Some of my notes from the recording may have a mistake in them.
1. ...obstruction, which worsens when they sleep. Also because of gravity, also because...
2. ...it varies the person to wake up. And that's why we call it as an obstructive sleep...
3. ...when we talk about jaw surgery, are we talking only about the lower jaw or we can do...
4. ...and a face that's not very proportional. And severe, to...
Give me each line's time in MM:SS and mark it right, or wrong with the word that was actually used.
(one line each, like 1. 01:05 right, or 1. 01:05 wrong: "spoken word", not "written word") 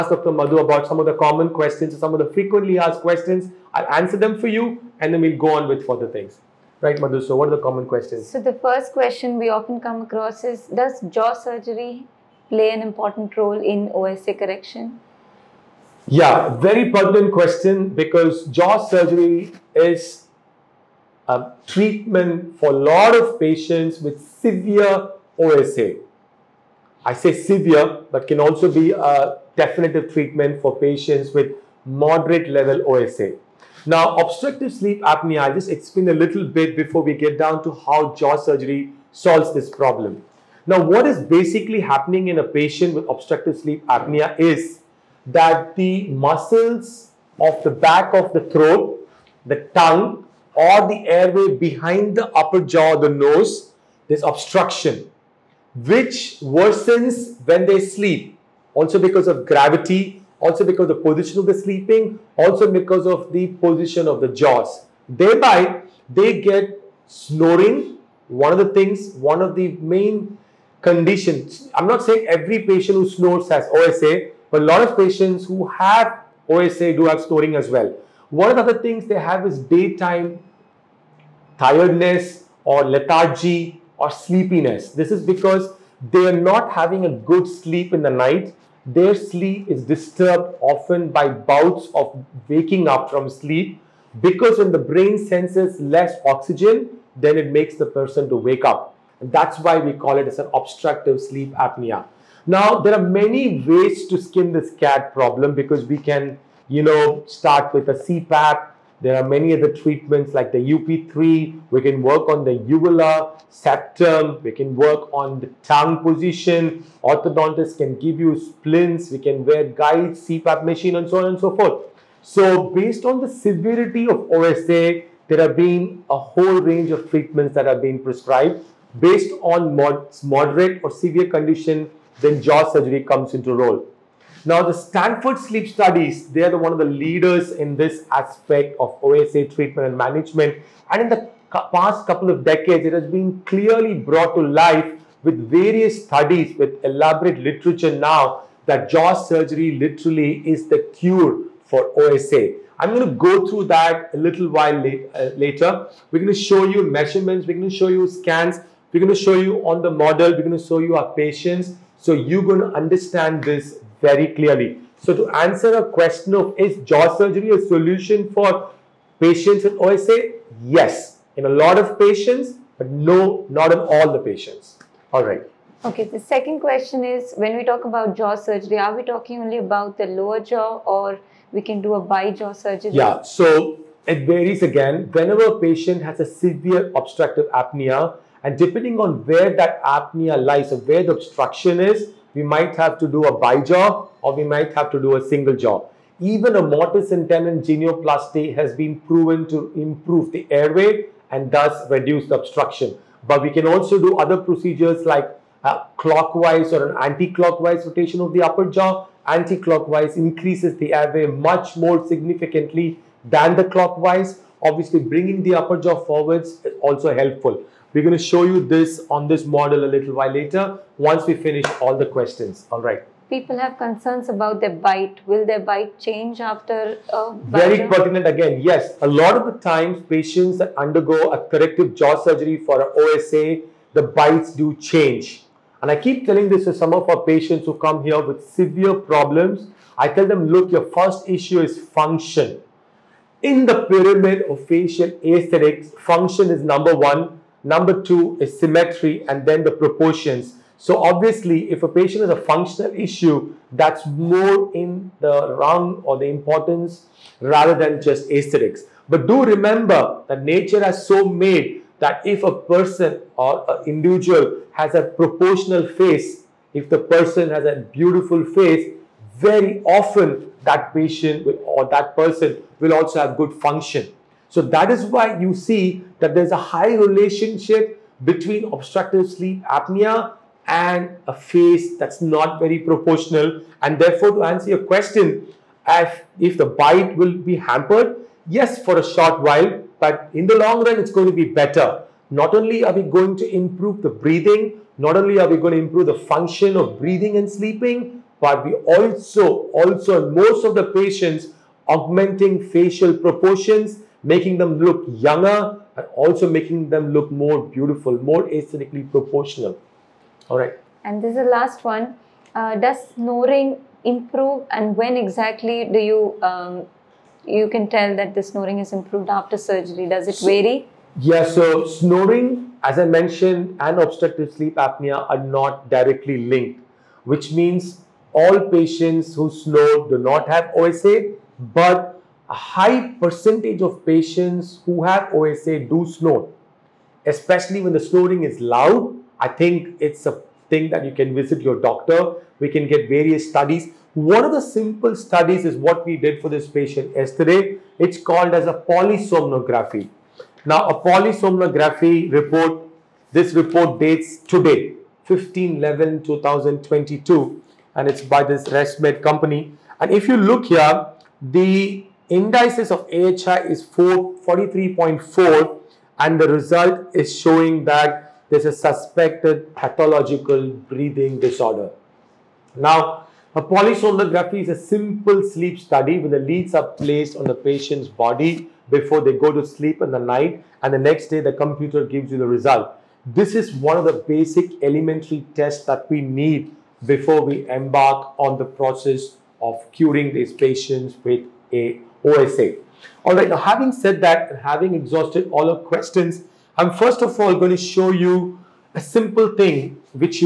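1. 00:54 right
2. 01:37 wrong: "makes", not "varies"
3. 02:57 right
4. 04:40 wrong: "therefore", not "severe".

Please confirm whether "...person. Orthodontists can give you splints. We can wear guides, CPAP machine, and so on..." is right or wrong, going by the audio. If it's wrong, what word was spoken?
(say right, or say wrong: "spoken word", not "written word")
wrong: "position", not "person".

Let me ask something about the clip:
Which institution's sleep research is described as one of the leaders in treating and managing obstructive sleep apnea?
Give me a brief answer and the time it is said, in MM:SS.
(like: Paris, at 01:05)
Stanford Sleep Studies, at 02:14.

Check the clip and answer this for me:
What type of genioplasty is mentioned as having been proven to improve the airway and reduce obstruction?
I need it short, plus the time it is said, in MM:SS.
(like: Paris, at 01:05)
mortise and tenon, at 03:16.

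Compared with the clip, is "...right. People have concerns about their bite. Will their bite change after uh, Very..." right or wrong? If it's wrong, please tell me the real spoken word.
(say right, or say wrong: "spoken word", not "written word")
right.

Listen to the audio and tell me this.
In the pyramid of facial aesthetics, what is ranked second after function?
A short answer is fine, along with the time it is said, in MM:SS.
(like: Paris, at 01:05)
symmetry, at 04:08.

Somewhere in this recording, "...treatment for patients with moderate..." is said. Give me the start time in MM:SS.
00:30.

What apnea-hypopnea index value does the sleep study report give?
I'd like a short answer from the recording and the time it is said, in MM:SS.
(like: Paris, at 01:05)
43.4, at 06:03.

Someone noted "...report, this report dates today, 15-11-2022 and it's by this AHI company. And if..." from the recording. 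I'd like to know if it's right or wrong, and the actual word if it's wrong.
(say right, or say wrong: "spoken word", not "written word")
wrong: "ResMed", not "AHI".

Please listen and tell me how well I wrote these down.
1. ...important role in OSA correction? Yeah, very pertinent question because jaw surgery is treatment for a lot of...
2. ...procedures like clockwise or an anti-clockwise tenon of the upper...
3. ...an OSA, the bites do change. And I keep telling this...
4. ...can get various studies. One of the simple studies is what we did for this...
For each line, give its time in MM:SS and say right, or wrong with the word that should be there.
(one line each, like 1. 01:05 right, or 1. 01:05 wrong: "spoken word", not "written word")
1. 00:12 right
2. 03:24 wrong: "rotation", not "tenon"
3. 03:52 right
4. 05:42 right.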